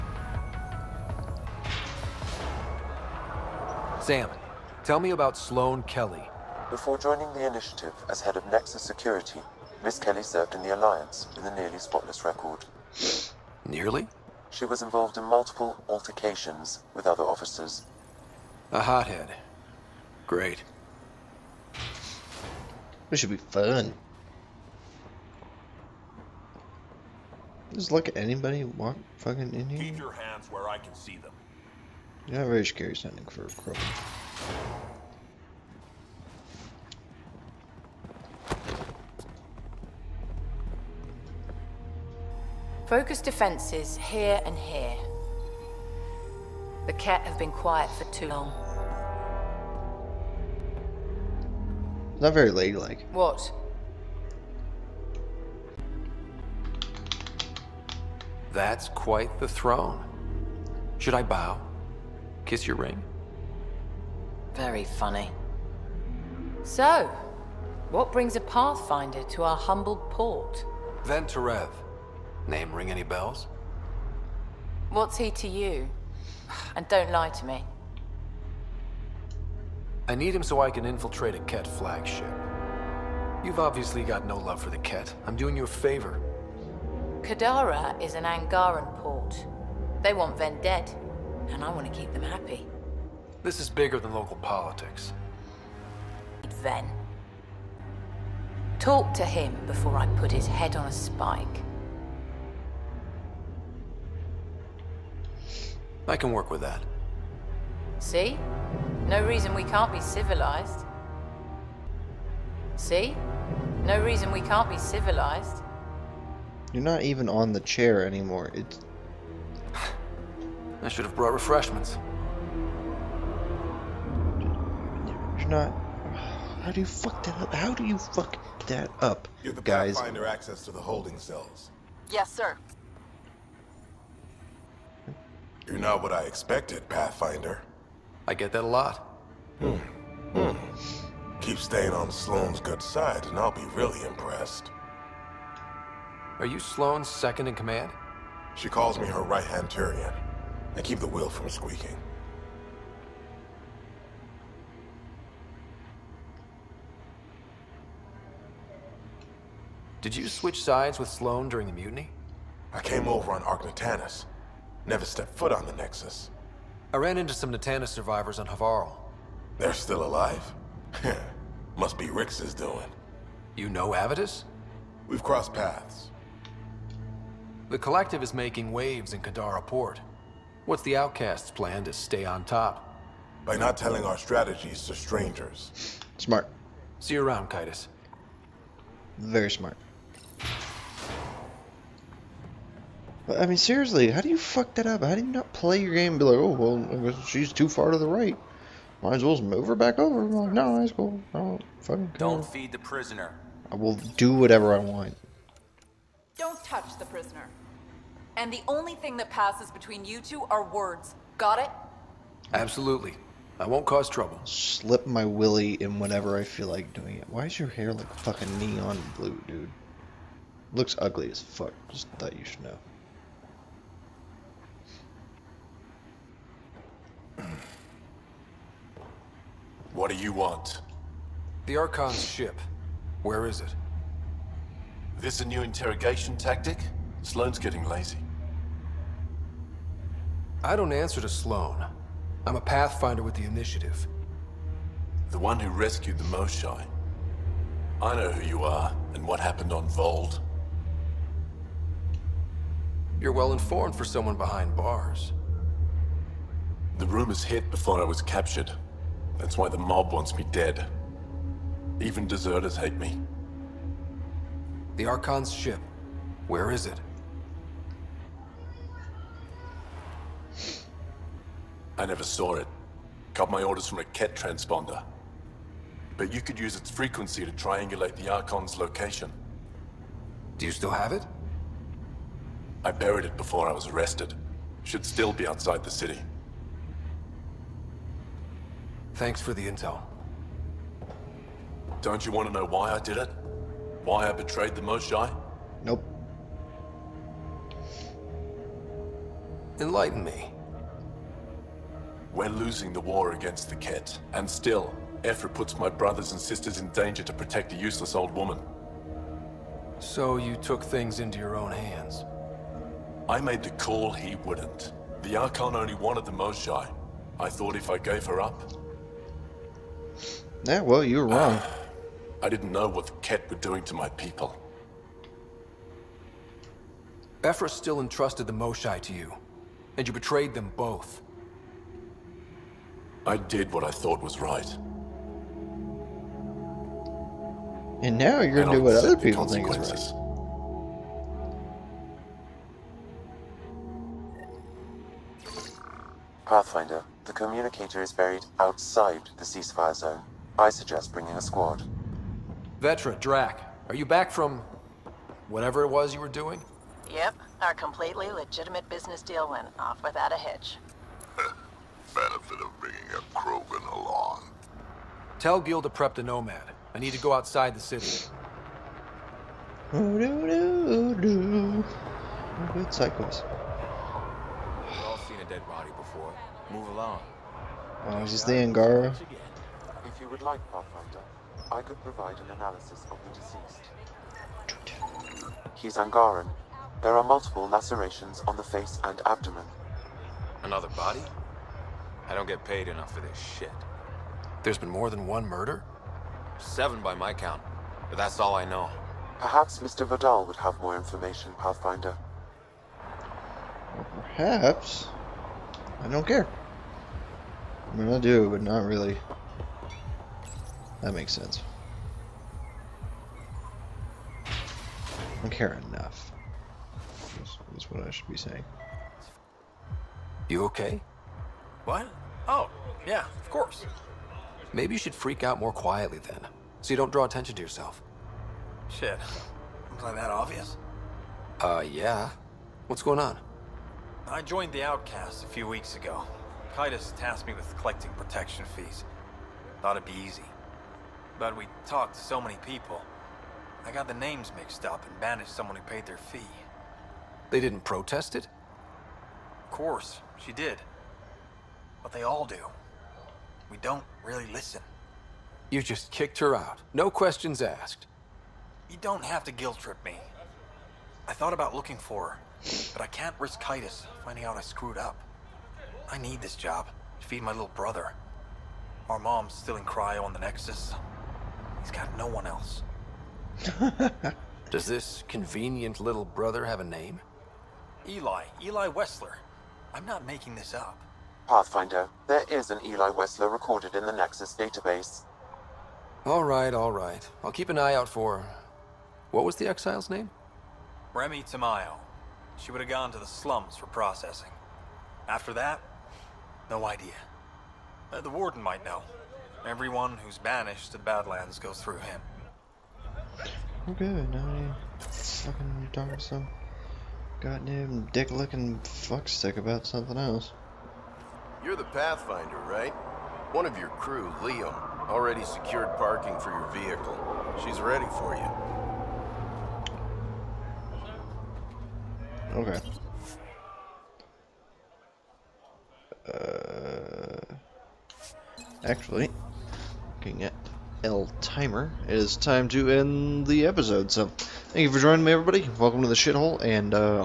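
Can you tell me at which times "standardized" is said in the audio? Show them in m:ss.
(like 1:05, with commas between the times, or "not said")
not said.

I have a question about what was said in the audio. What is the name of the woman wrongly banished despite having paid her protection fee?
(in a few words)
Remy Tamayo.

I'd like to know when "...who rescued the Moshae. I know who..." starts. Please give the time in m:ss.
4:05.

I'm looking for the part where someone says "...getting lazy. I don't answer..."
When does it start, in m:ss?
3:57.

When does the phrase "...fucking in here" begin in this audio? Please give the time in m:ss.
0:29.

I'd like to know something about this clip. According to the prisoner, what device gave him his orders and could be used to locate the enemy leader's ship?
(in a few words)
A Kett transponder.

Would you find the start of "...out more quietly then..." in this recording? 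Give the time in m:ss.
7:05.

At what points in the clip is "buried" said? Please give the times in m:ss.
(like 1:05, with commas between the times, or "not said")
4:42, 5:48.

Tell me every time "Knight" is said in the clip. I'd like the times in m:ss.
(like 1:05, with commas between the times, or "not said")
not said.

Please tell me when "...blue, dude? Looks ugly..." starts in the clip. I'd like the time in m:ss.
3:39.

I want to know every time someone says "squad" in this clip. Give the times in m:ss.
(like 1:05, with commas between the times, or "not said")
5:51.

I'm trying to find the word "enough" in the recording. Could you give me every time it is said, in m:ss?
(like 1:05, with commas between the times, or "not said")
6:32, 6:55.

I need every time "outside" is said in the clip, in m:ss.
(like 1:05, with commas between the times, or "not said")
4:45, 5:48, 6:07.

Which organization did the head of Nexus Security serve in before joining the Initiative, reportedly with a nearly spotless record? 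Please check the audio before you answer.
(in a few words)
The Alliance.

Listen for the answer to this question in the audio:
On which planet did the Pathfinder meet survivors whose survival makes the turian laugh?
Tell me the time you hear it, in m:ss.
2:48.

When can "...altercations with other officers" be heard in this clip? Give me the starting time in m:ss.
0:15.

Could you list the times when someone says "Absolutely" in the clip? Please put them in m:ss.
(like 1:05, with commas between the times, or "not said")
3:32.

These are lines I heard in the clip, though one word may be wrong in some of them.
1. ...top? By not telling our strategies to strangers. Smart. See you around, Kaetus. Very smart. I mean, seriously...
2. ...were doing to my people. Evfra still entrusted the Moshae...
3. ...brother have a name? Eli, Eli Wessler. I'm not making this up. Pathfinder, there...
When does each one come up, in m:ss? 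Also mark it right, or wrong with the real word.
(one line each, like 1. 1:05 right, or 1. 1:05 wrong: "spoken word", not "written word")
1. 3:02 right
2. 5:23 right
3. 7:56 right.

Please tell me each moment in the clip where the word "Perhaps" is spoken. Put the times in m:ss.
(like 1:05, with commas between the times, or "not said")
6:39, 6:44.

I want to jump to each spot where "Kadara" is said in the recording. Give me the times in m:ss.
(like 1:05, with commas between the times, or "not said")
1:27, 2:59.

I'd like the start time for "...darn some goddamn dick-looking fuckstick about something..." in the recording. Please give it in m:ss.
8:25.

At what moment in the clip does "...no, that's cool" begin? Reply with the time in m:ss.
3:20.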